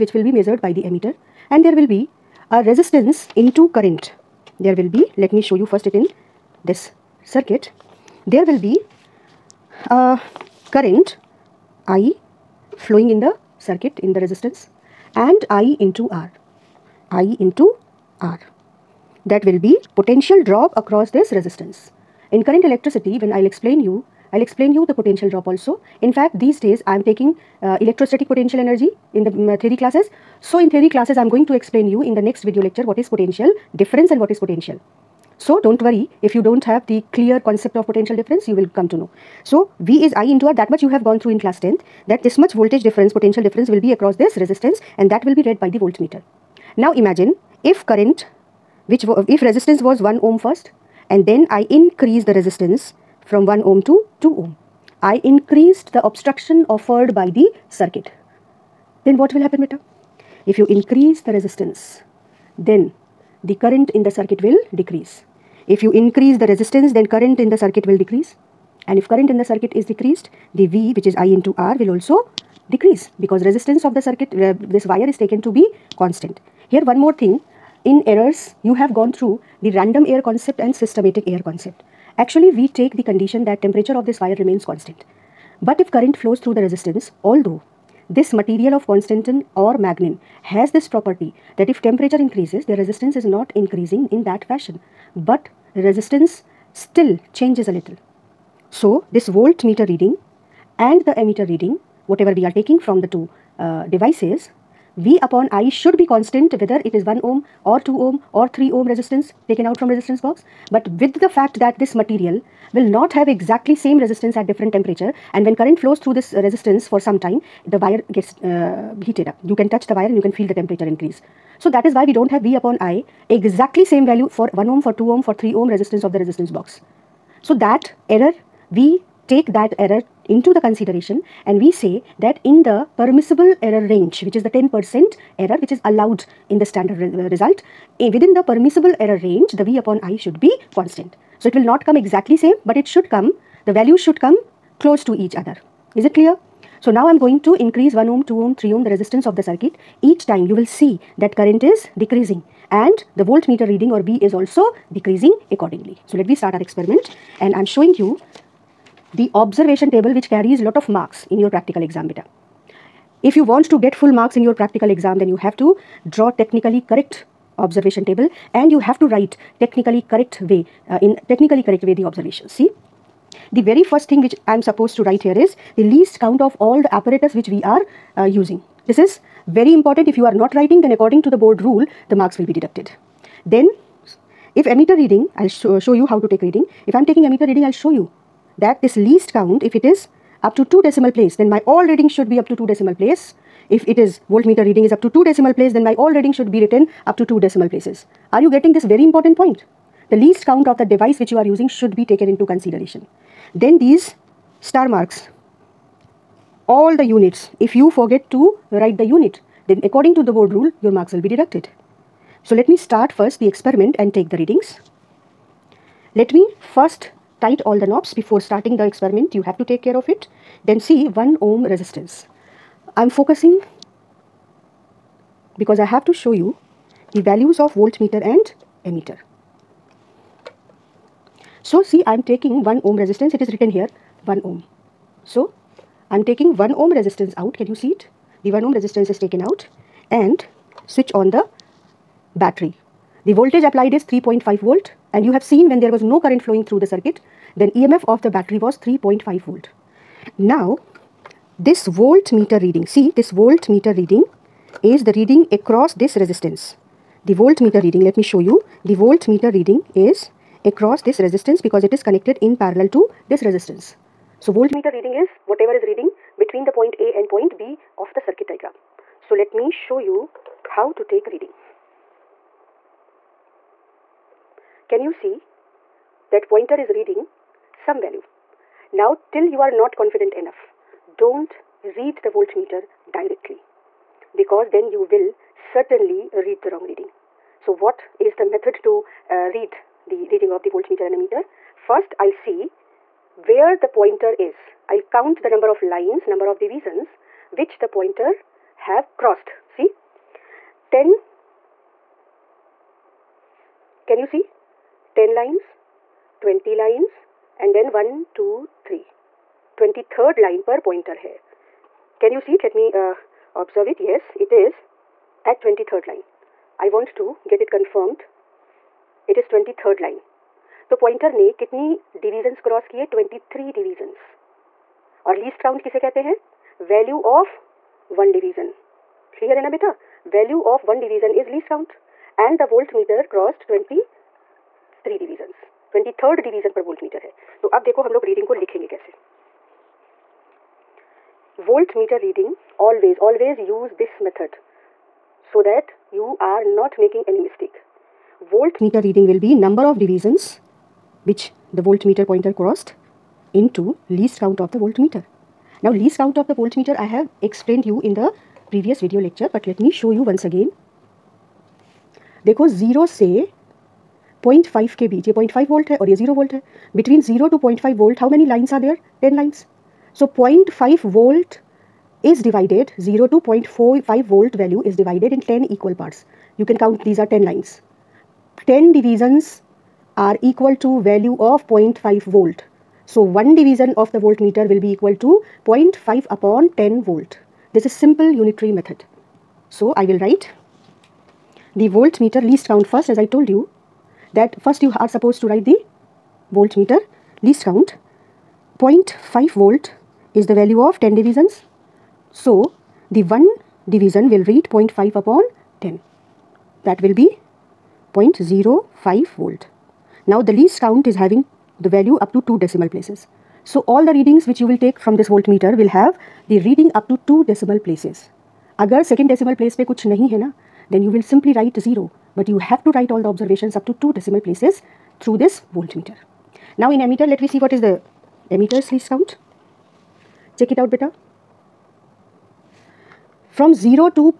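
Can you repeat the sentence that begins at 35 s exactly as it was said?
So don't worry if you don't have the clear concept of potential difference you will come to know.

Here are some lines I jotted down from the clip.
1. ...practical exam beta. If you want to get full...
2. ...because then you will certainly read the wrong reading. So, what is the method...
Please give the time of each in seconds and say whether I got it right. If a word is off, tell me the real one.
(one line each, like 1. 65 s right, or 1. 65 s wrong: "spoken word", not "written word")
1. 161 s right
2. 284 s right.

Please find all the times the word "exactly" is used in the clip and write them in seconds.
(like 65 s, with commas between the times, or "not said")
113 s, 123 s, 142 s.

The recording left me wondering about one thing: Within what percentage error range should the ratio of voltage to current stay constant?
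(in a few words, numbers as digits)
10%.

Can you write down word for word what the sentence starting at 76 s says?
Here one more thing, in errors you have gone through the random error concept and systematic error concept.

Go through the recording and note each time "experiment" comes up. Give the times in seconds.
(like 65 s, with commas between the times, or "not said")
156 s, 213 s, 218 s.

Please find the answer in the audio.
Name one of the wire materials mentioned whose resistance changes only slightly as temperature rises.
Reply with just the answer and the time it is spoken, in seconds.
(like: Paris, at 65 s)
Manganin, at 89 s.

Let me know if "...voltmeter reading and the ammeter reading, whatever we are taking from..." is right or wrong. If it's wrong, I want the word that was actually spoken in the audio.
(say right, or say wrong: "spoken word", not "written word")
right.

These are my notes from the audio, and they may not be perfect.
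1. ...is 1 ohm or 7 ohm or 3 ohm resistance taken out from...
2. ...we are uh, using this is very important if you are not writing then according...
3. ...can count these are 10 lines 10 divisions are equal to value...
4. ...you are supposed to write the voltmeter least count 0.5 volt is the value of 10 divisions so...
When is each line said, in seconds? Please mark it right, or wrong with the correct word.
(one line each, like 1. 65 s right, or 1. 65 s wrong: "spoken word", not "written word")
1. 106 s wrong: "2", not "7"
2. 177 s right
3. 376 s right
4. 394 s right.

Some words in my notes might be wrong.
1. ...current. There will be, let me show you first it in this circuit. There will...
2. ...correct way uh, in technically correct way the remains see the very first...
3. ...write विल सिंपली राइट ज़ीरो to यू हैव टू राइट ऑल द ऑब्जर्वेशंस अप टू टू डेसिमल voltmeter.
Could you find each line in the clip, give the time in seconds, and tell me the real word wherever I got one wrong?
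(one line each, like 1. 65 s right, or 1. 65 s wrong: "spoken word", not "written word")
1. 3 s right
2. 170 s wrong: "observations", not "remains"
3. 421 s right.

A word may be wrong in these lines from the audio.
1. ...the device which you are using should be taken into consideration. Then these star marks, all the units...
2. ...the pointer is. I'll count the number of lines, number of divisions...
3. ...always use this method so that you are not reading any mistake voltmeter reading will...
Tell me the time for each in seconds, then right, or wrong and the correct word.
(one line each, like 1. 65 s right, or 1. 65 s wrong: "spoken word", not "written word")
1. 200 s right
2. 293 s right
3. 343 s wrong: "making", not "reading".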